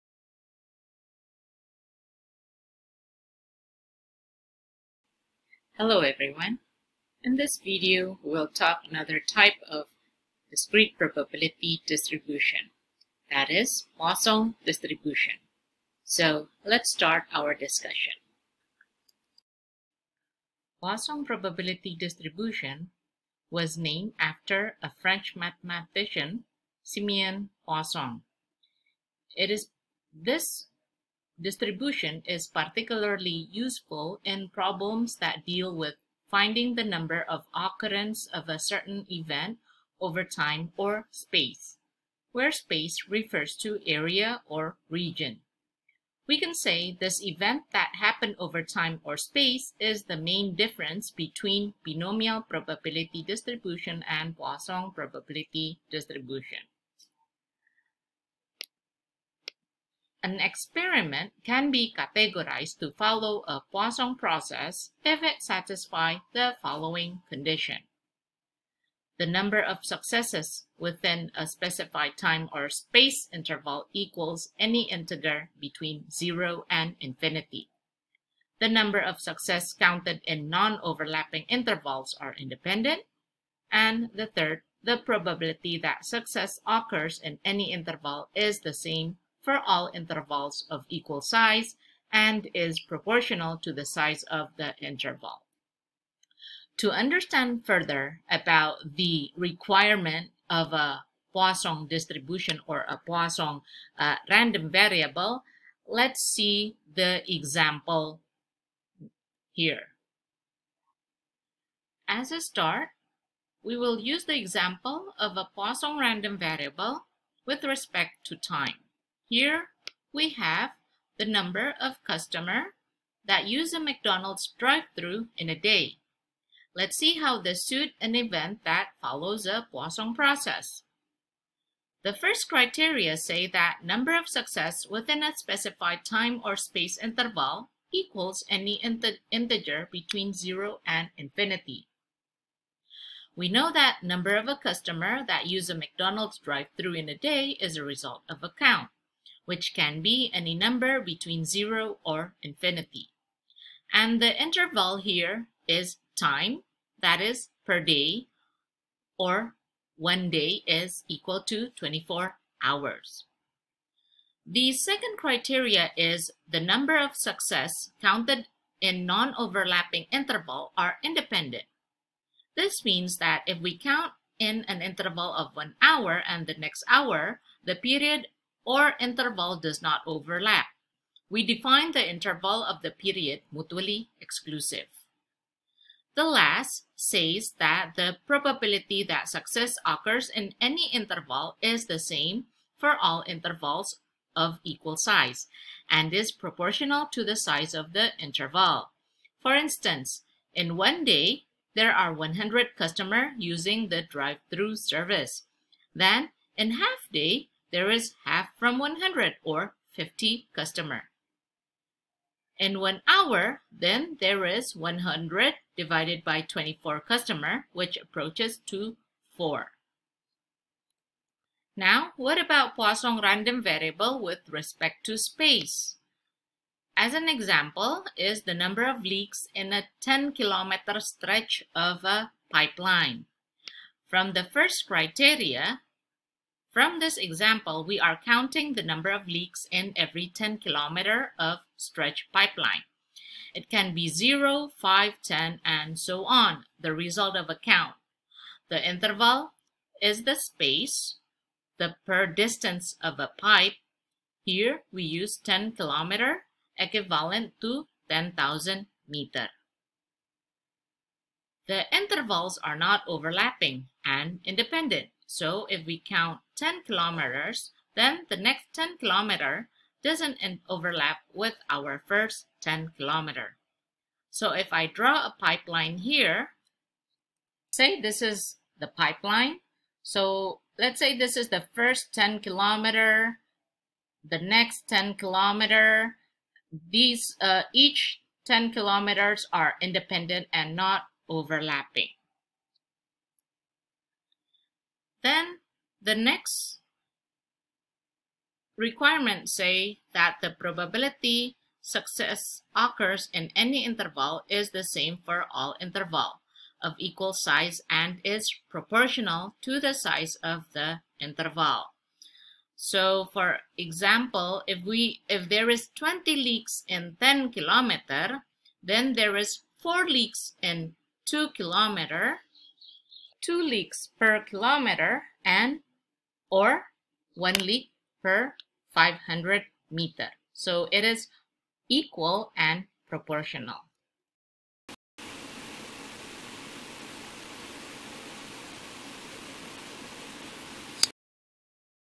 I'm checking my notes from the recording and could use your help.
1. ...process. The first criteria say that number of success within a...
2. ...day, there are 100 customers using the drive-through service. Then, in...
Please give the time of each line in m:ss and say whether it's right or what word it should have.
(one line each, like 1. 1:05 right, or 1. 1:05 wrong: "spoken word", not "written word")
1. 2:10 right
2. 3:21 right.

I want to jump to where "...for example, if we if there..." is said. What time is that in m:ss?
5:13.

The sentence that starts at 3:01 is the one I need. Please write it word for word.
We define the interval of the period mutually exclusive.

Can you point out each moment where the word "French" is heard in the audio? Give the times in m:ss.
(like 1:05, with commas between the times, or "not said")
0:25.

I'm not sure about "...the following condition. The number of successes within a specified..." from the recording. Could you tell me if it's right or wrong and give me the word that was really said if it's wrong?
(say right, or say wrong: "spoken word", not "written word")
right.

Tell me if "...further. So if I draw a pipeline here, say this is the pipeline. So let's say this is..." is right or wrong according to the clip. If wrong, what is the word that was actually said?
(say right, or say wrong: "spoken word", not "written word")
wrong: "kilometer", not "further".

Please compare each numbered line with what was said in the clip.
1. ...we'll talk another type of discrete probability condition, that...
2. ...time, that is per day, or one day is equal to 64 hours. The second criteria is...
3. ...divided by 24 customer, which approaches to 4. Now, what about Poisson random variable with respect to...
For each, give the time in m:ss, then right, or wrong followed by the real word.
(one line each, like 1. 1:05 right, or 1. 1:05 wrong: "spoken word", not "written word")
1. 0:08 wrong: "distribution", not "condition"
2. 2:36 wrong: "24", not "64"
3. 3:35 right.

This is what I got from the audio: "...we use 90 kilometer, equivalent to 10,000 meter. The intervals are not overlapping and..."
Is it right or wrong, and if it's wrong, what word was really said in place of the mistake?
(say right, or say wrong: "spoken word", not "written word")
wrong: "10", not "90".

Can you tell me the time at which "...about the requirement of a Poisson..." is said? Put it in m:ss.
1:38.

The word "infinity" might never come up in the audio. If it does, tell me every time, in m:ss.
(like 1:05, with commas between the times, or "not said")
1:16, 2:21, 2:32.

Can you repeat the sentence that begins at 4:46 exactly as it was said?
These, uh, each 10 kilometers are independent and not overlapping.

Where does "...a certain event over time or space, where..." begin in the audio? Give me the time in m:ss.
0:38.